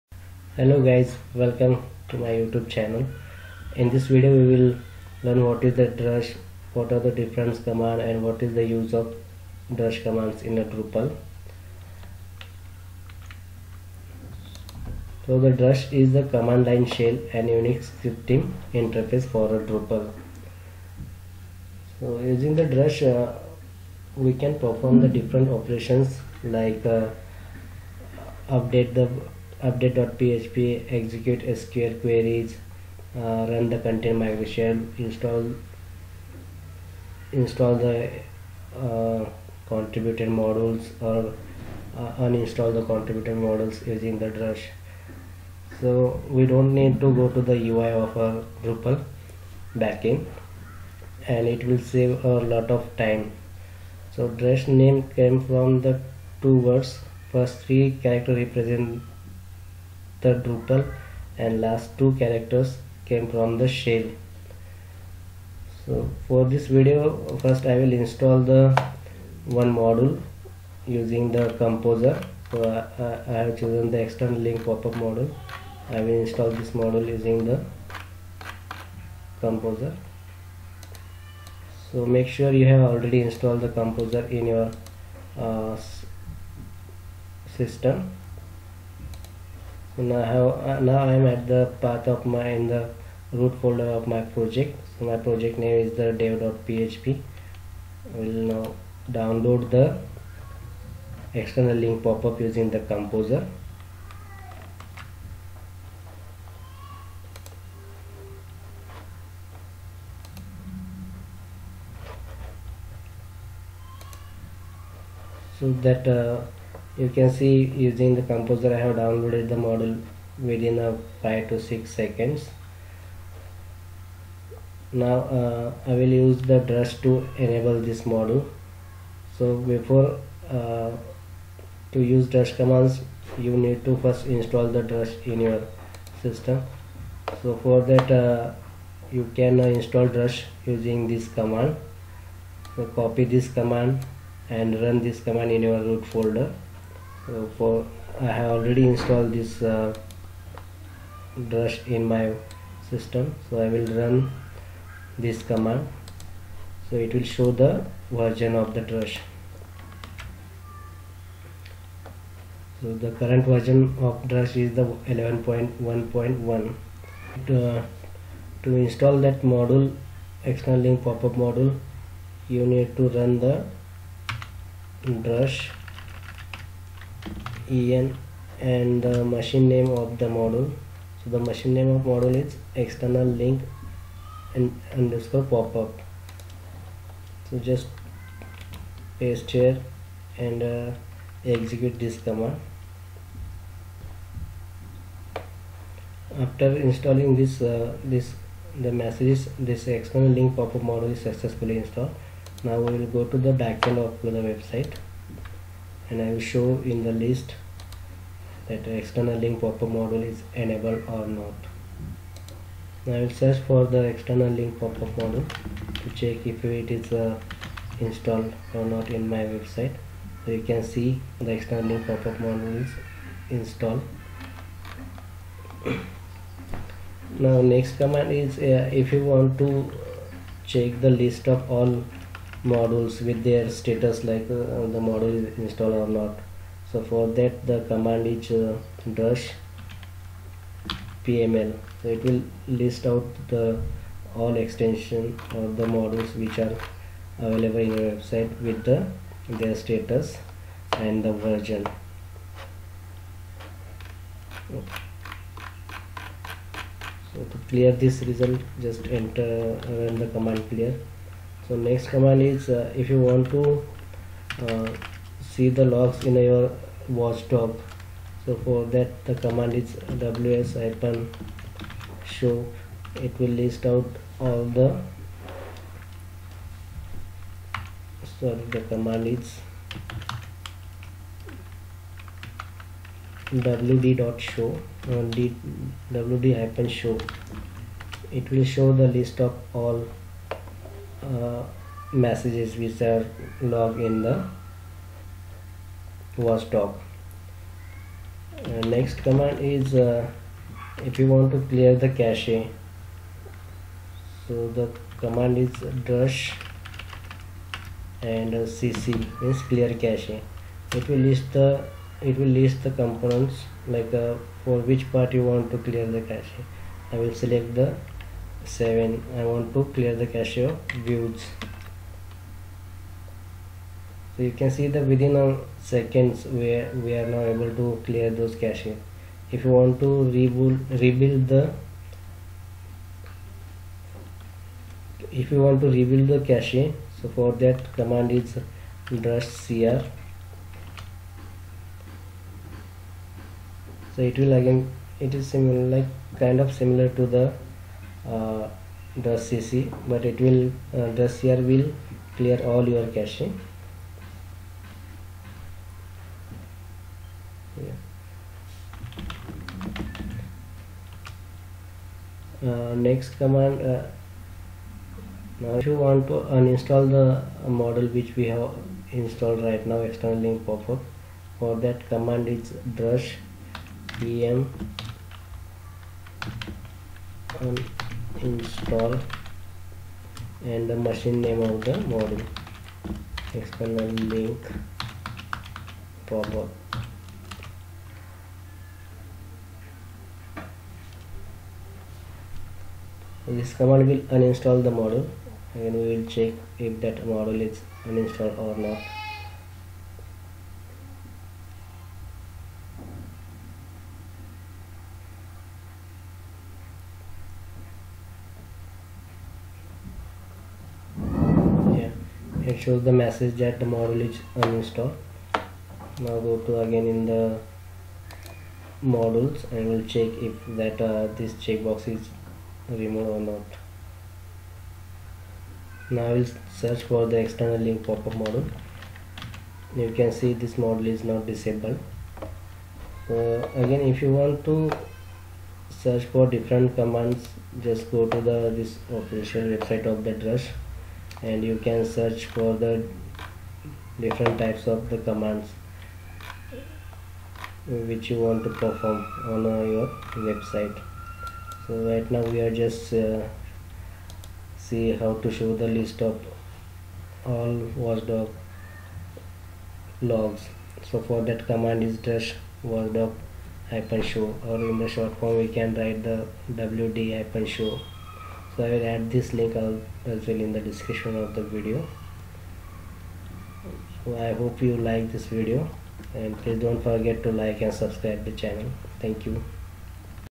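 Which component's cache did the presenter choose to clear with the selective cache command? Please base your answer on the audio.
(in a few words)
views.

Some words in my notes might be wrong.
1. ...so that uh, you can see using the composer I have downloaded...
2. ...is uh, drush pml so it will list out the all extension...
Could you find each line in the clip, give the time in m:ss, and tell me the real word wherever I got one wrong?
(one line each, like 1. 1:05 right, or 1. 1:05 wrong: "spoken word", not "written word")
1. 1:55 right
2. 3:58 right.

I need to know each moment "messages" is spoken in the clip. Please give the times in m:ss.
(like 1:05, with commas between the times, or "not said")
3:18, 4:52, 6:53.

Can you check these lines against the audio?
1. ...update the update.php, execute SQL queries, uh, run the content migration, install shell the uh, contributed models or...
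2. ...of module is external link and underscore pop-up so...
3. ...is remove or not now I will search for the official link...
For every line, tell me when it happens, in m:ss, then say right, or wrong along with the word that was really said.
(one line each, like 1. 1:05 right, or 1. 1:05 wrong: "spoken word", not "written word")
1. 0:28 wrong: "install", not "shell"
2. 3:01 right
3. 7:02 wrong: "external", not "official".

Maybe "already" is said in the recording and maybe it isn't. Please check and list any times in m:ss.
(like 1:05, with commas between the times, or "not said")
1:22, 2:28.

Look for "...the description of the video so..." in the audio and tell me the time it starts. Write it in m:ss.
7:50.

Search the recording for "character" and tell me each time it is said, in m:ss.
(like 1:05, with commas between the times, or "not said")
0:58, 1:02.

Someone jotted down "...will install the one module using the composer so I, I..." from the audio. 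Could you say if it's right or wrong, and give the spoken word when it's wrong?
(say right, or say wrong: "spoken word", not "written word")
right.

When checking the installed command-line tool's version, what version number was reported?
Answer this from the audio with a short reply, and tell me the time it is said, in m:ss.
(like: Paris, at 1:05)
11.1.1, at 2:45.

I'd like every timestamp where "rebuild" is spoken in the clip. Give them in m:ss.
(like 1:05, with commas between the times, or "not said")
5:31, 5:35.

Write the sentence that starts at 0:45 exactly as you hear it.
So we don't need to go to the UI of our Drupal backend and it will save a lot of time.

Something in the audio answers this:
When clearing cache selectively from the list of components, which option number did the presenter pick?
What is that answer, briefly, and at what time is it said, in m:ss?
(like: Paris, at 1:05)
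7, at 5:18.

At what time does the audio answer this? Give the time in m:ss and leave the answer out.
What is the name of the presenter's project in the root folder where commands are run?
1:36.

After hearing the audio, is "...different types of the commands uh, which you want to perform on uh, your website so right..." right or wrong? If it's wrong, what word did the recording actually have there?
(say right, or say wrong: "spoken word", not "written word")
right.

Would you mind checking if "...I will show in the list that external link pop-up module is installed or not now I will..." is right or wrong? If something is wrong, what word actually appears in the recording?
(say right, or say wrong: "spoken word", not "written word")
wrong: "enabled", not "installed".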